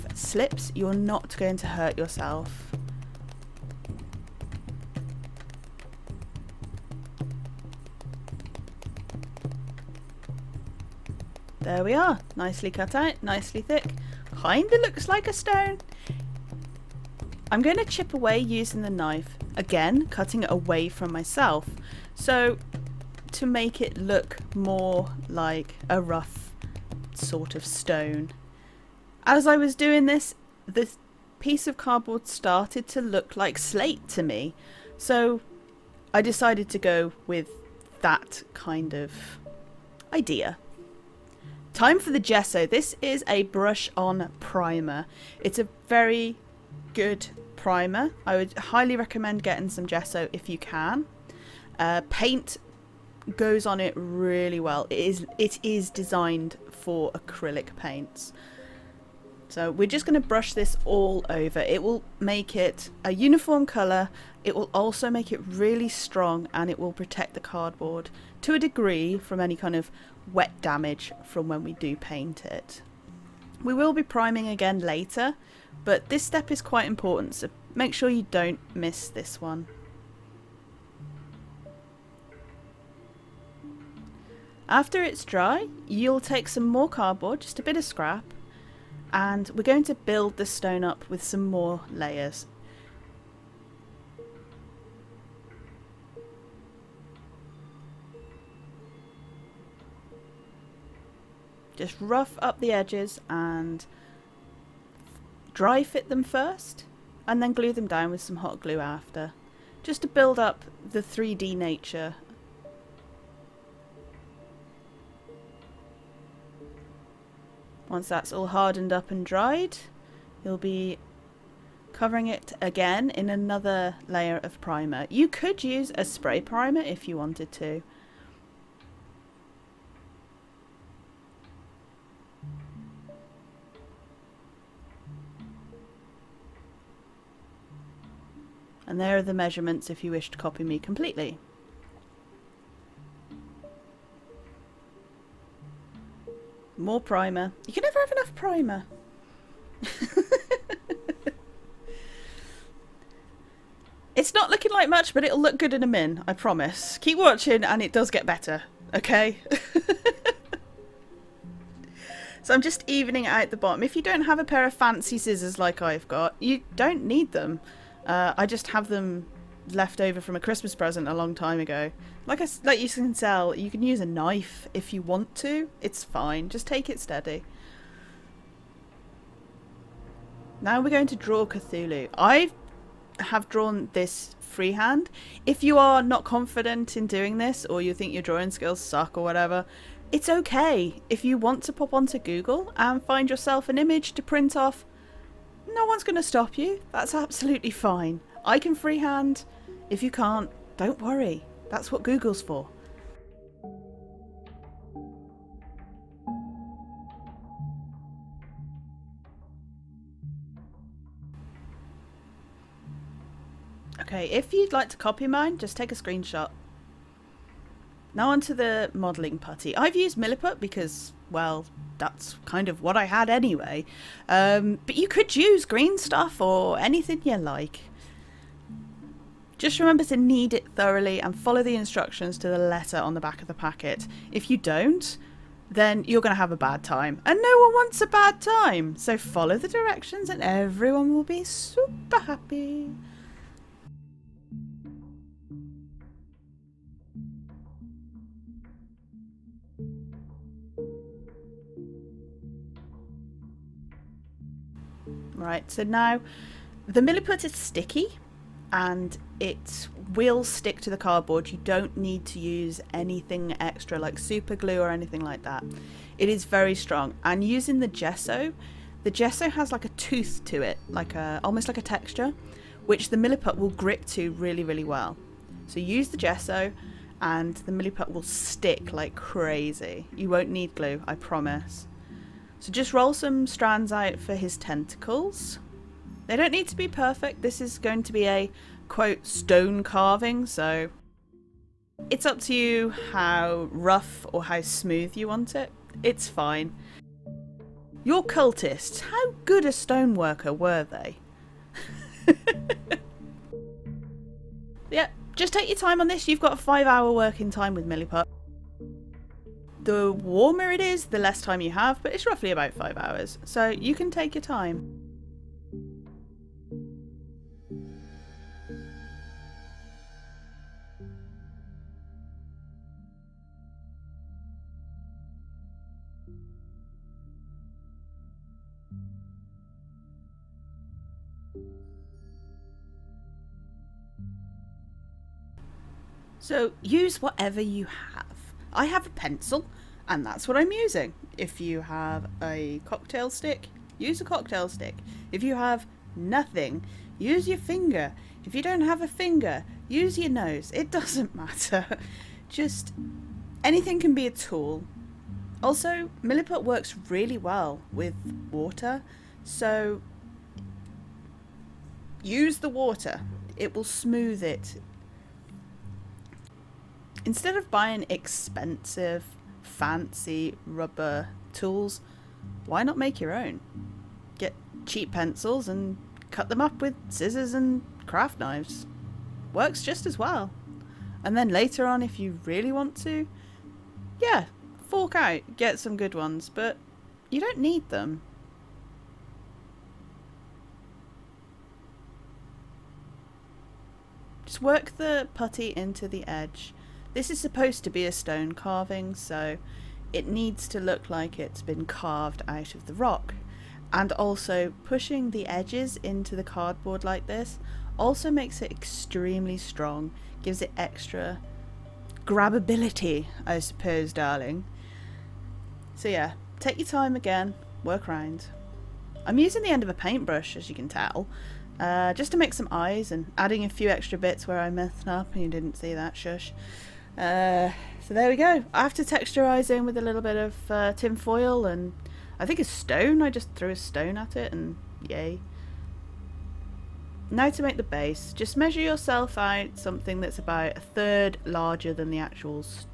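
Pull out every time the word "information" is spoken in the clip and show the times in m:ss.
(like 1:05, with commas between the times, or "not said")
not said.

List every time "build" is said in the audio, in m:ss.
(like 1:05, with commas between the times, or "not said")
1:29, 1:50.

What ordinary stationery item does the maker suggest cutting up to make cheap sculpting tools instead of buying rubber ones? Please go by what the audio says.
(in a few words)
Pencils.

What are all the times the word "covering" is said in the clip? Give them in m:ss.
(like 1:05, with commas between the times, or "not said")
2:01.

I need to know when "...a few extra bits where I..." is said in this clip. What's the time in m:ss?
7:03.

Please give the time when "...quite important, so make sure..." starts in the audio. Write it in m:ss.
1:16.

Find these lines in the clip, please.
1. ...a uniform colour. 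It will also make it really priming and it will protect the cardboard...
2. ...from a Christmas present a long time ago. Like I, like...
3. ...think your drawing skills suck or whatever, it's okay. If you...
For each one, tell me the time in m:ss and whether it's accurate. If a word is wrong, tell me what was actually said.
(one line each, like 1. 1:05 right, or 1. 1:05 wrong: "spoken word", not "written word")
1. 1:03 wrong: "strong", not "priming"
2. 2:50 right
3. 3:07 right.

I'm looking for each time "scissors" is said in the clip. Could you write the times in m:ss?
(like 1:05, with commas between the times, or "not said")
2:45, 6:17.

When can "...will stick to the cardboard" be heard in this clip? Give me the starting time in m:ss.
4:20.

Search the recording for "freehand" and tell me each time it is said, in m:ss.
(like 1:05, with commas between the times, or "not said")
3:04, 3:18.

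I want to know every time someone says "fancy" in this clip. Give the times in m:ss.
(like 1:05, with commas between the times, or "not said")
2:44, 6:09.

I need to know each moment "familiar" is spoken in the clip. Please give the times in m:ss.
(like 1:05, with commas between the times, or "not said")
not said.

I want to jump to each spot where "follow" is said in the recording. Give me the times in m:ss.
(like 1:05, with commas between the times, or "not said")
3:51, 3:59.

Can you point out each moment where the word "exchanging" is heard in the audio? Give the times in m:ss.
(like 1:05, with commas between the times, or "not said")
not said.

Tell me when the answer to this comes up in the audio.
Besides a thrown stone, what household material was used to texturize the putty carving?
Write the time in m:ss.
7:10.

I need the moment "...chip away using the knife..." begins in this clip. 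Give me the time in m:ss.
0:17.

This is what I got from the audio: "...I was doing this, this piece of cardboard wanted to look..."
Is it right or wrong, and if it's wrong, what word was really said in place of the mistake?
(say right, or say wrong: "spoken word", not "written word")
wrong: "started", not "wanted".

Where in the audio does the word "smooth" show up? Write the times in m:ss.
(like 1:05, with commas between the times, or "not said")
4:54, 6:03.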